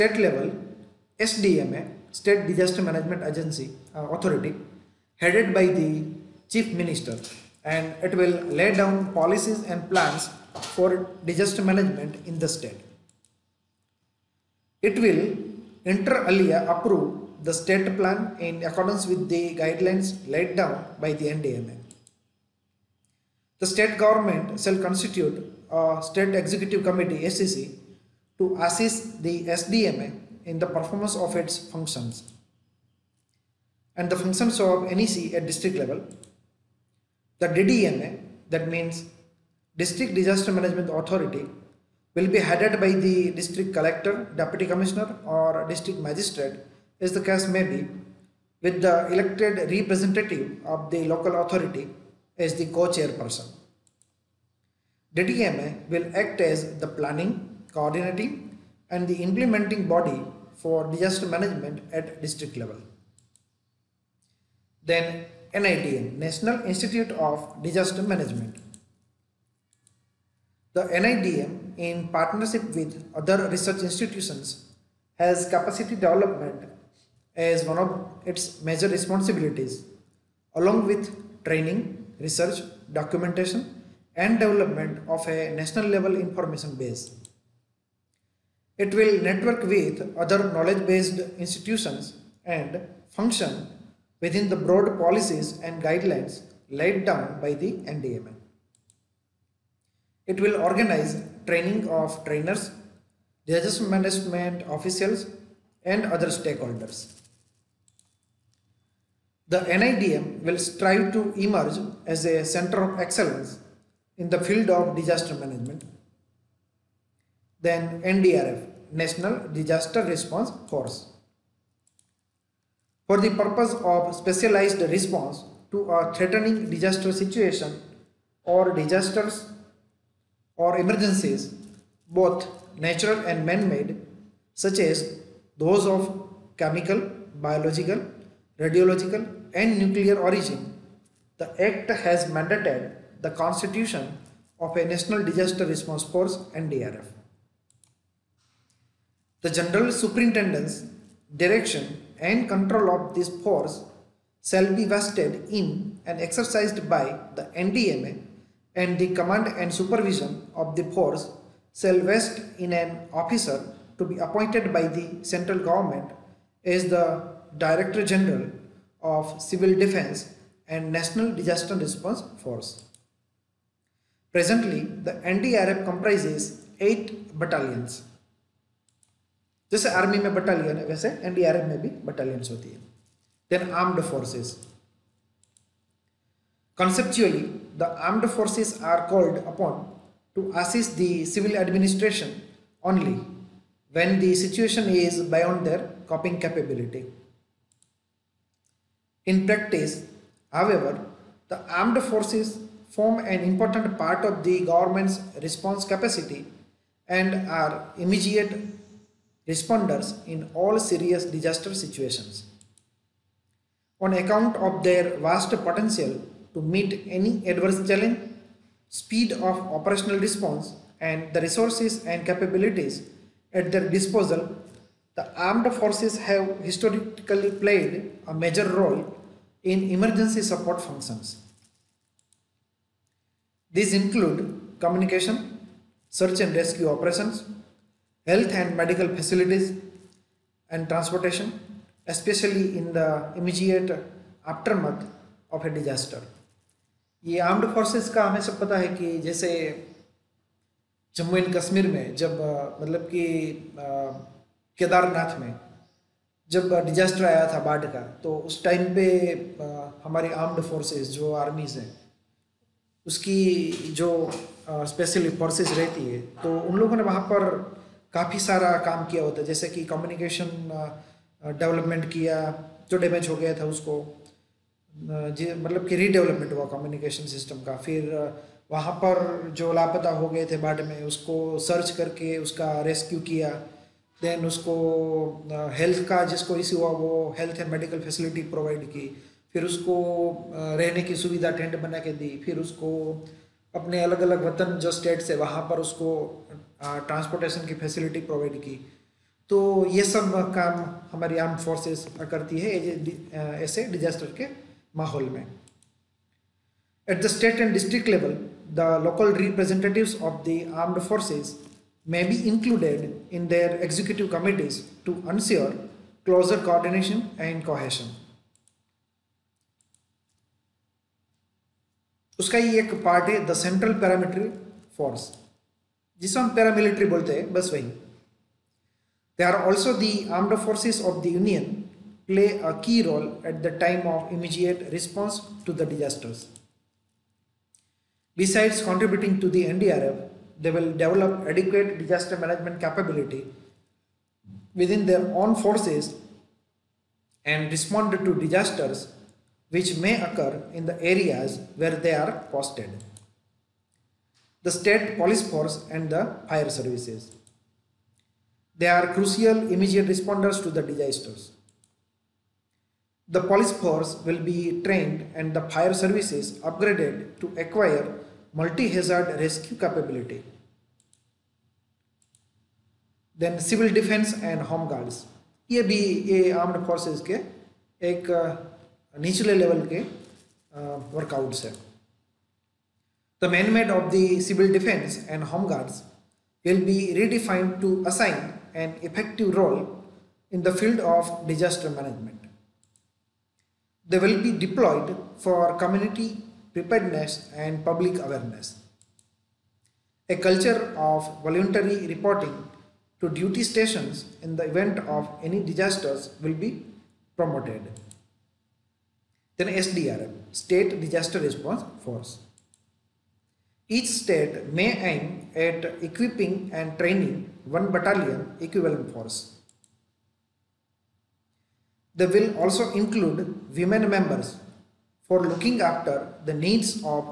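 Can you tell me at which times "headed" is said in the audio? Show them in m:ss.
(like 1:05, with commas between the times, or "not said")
0:05, 0:42.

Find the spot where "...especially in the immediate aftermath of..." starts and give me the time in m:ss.
4:02.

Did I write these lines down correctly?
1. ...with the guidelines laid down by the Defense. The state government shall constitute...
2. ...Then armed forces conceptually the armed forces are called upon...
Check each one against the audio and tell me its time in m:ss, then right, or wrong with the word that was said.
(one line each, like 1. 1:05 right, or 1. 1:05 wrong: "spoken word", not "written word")
1. 0:19 wrong: "NDMA", not "Defense"
2. 3:03 right.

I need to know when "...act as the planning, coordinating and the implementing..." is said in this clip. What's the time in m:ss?
0:56.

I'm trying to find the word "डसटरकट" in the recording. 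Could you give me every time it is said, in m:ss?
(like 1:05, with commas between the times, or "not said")
5:07.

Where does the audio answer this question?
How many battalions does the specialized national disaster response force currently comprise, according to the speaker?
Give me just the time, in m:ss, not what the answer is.
2:56.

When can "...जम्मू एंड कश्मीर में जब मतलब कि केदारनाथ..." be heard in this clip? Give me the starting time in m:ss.
4:11.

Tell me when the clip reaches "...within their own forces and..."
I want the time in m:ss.
5:44.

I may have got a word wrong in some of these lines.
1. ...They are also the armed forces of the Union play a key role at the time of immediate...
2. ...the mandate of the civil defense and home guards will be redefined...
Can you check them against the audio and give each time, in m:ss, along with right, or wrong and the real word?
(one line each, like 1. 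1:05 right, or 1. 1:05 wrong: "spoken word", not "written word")
1. 5:29 right
2. 6:23 right.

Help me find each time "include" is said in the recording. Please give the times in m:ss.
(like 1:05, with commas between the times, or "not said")
3:53, 7:02.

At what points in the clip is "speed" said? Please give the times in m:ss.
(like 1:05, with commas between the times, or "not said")
3:38.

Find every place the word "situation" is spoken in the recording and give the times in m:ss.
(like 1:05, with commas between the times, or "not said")
2:07, 3:14, 3:31.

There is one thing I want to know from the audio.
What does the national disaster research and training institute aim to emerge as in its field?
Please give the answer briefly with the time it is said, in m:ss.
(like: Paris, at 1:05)
center of excellence, at 1:52.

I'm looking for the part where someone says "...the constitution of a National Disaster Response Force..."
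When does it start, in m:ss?
2:23.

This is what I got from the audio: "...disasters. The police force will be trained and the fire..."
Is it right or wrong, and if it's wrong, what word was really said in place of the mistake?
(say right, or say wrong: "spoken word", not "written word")
right.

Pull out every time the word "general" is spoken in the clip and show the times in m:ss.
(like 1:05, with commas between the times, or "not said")
2:29, 2:48.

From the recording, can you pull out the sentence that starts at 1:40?
It will organize training of trainers, disaster management officials, and other stakeholders.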